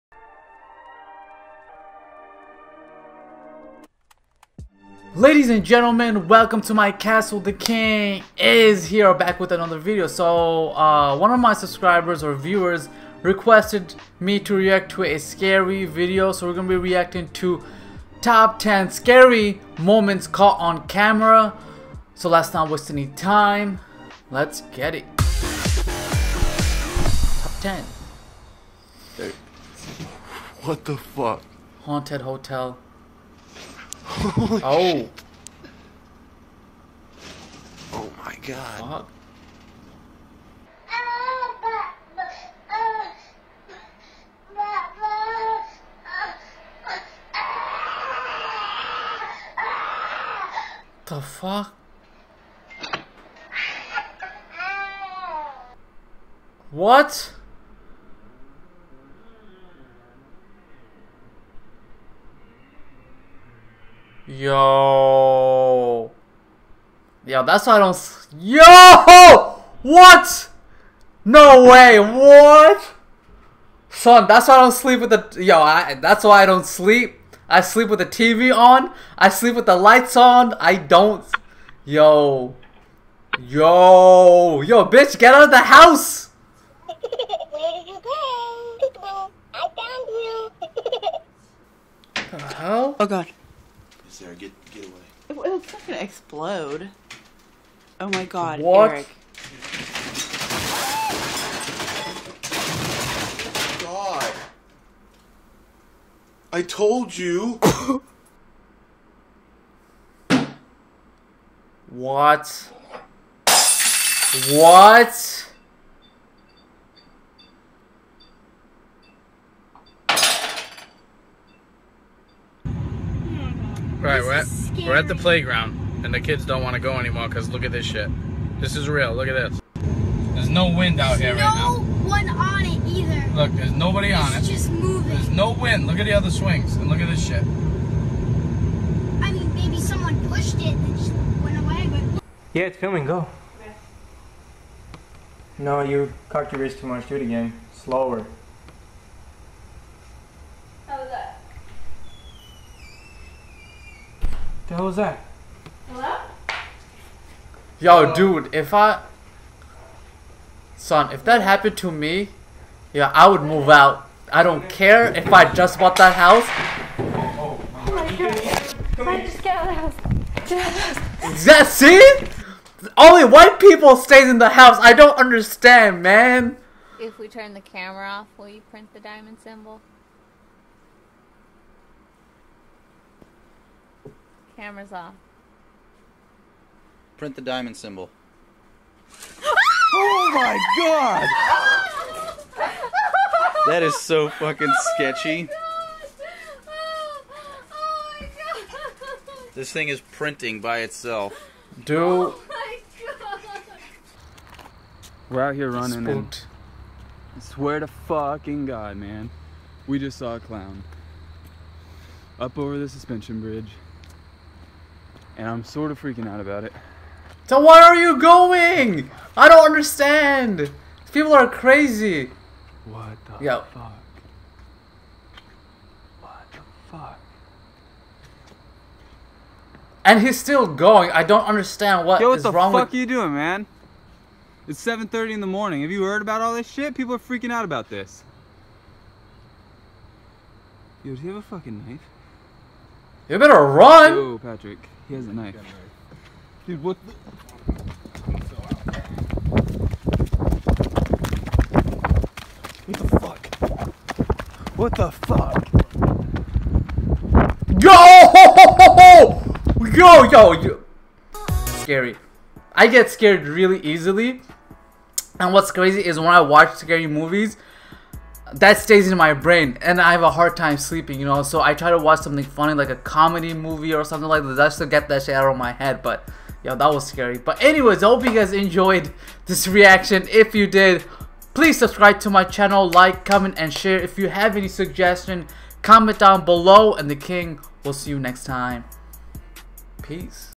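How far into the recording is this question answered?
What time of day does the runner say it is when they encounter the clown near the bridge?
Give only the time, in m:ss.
3:54.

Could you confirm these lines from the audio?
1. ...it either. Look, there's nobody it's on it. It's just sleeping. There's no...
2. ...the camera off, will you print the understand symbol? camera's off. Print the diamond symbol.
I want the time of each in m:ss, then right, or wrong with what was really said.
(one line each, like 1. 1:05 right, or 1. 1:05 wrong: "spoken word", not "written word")
1. 2:12 wrong: "moving", not "sleeping"
2. 2:57 wrong: "diamond", not "understand".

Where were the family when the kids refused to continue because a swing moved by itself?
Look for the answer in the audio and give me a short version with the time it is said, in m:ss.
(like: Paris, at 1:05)
the playground, at 2:05.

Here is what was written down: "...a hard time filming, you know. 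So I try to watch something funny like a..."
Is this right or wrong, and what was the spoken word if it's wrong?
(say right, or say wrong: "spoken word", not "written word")
wrong: "sleeping", not "filming".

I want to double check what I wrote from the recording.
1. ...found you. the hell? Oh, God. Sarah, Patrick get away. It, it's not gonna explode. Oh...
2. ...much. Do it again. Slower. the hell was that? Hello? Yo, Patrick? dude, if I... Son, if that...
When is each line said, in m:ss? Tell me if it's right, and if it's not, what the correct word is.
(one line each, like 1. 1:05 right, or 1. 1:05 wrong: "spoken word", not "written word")
1. 1:29 wrong: "Get", not "Patrick"
2. 2:26 wrong: "Hello", not "Patrick".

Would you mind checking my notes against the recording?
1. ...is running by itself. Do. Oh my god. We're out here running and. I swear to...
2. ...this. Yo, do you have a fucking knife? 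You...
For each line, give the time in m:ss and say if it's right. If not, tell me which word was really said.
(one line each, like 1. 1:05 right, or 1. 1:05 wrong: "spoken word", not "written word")
1. 3:19 wrong: "printing", not "running"
2. 3:57 right.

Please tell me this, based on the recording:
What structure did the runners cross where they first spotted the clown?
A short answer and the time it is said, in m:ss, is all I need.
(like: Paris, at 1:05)
suspension bridge, at 3:32.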